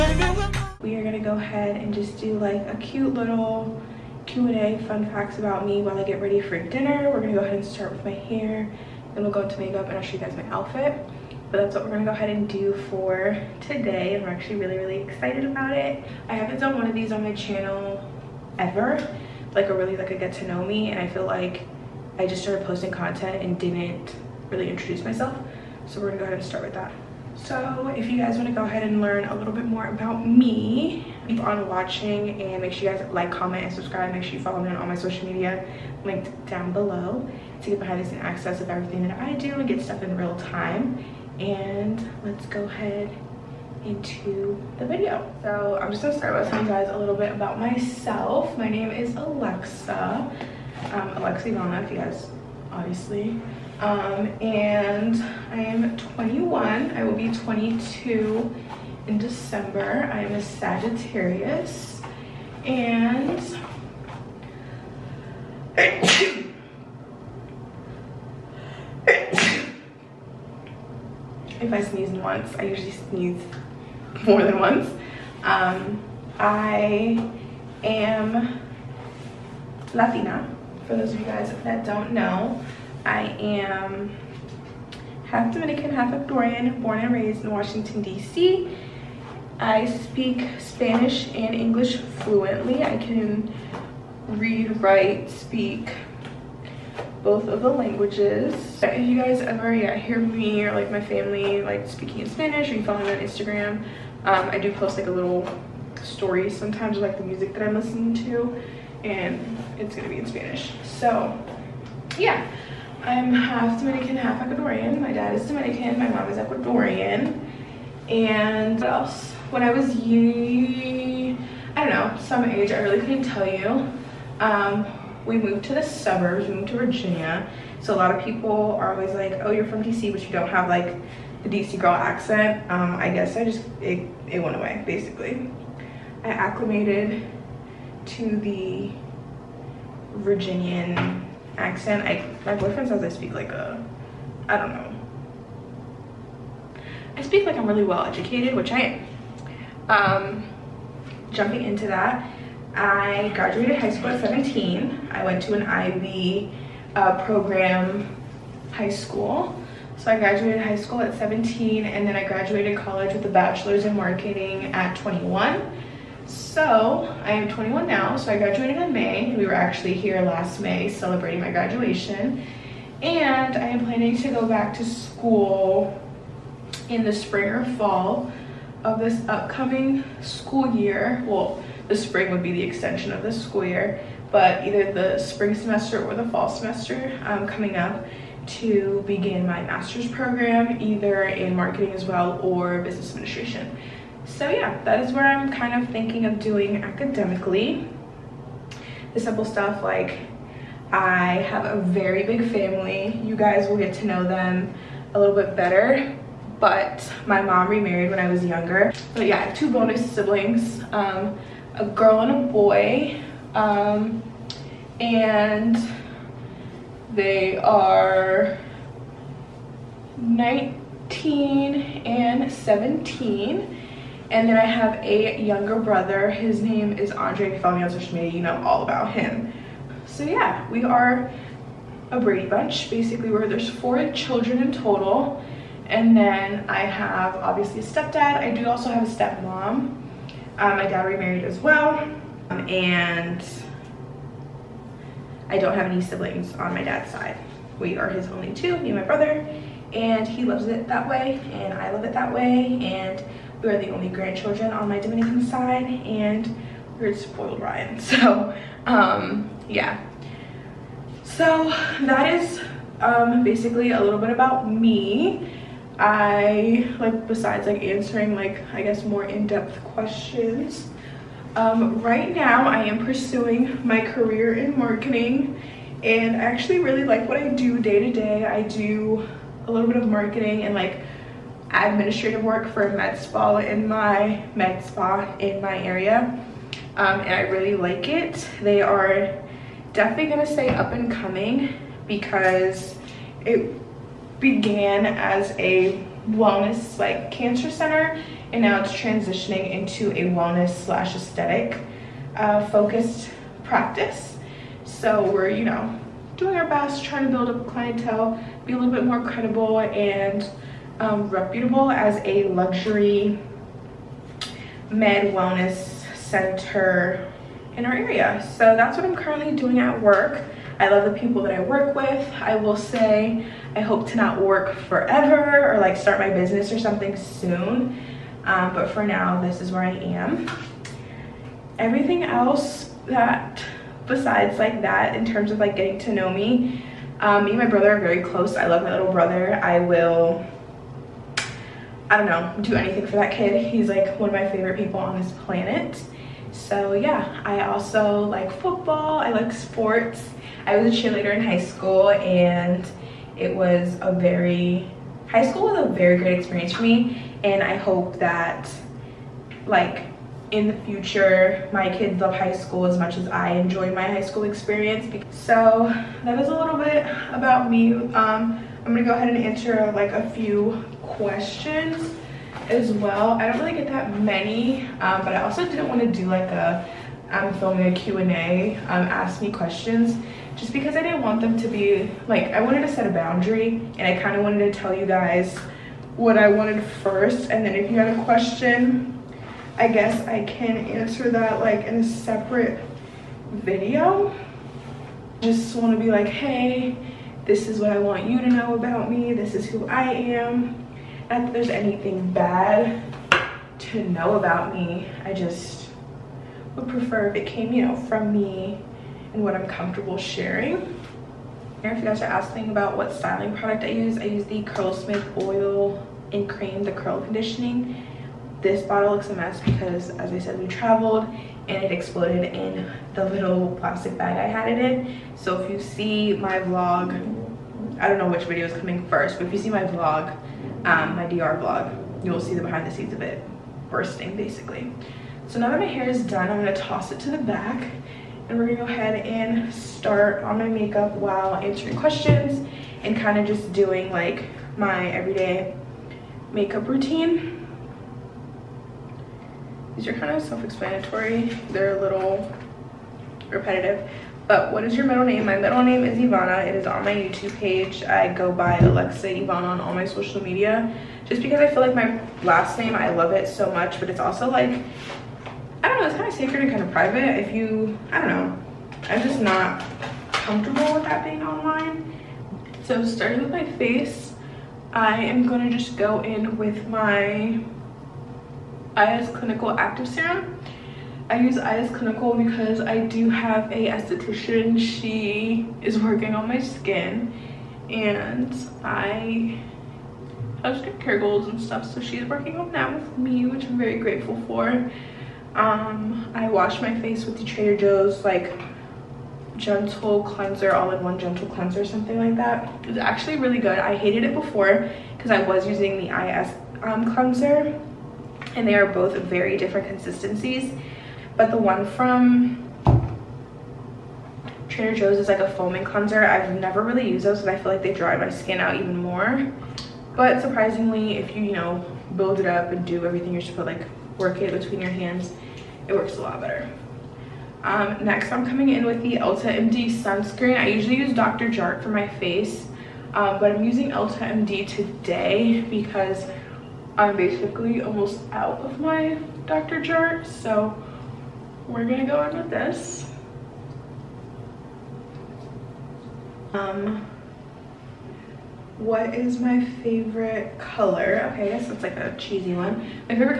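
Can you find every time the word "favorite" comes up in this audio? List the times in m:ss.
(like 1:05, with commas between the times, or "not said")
5:44, 9:09.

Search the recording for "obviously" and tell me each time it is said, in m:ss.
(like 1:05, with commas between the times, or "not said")
0:52, 3:57.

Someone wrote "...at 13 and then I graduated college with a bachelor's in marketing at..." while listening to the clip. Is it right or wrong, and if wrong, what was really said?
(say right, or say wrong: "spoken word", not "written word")
wrong: "17", not "13".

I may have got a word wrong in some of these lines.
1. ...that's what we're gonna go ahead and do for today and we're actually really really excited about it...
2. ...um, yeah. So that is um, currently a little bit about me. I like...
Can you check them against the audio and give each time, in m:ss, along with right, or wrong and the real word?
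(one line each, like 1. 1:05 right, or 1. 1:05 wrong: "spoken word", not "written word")
1. 0:11 right
2. 4:18 wrong: "basically", not "currently".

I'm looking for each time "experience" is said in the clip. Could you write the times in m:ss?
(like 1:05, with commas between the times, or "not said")
5:56, 6:04.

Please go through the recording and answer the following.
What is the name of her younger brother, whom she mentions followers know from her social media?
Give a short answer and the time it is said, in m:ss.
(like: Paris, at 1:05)
Andre, at 3:47.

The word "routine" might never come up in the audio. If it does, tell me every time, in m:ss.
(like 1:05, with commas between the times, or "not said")
7:26.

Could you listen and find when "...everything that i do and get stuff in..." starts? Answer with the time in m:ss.
0:38.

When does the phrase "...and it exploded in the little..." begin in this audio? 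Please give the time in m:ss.
7:01.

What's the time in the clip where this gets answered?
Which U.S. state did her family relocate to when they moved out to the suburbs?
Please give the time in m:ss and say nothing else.
2:06.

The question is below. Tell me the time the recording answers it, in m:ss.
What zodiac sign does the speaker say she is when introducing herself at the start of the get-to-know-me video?
1:00.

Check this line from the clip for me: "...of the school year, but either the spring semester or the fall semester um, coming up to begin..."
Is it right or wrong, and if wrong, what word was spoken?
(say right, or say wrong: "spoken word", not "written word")
right.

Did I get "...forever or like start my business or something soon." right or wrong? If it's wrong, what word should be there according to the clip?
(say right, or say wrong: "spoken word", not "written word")
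right.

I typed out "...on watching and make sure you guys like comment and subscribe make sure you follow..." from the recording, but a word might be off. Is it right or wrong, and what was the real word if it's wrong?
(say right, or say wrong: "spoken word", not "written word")
right.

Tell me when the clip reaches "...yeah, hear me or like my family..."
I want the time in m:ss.
1:39.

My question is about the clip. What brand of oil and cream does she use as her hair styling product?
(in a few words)
Curlsmith.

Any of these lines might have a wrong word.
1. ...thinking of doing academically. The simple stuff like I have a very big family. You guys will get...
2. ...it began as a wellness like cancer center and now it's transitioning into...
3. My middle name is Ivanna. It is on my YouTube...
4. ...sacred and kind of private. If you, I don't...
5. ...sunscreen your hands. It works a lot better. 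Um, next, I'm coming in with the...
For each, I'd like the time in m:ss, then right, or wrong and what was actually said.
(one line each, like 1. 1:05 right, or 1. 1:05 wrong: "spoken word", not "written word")
1. 3:15 right
2. 4:53 right
3. 7:35 right
4. 7:46 right
5. 8:44 wrong: "between", not "sunscreen".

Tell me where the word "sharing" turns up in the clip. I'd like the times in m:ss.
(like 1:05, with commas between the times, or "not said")
6:50.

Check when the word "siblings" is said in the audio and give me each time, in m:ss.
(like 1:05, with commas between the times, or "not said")
3:30, 4:06.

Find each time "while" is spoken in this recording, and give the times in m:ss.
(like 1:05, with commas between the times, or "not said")
0:05, 7:21.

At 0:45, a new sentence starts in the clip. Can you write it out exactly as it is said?
So I'm just gonna start by telling you guys a little bit about myself.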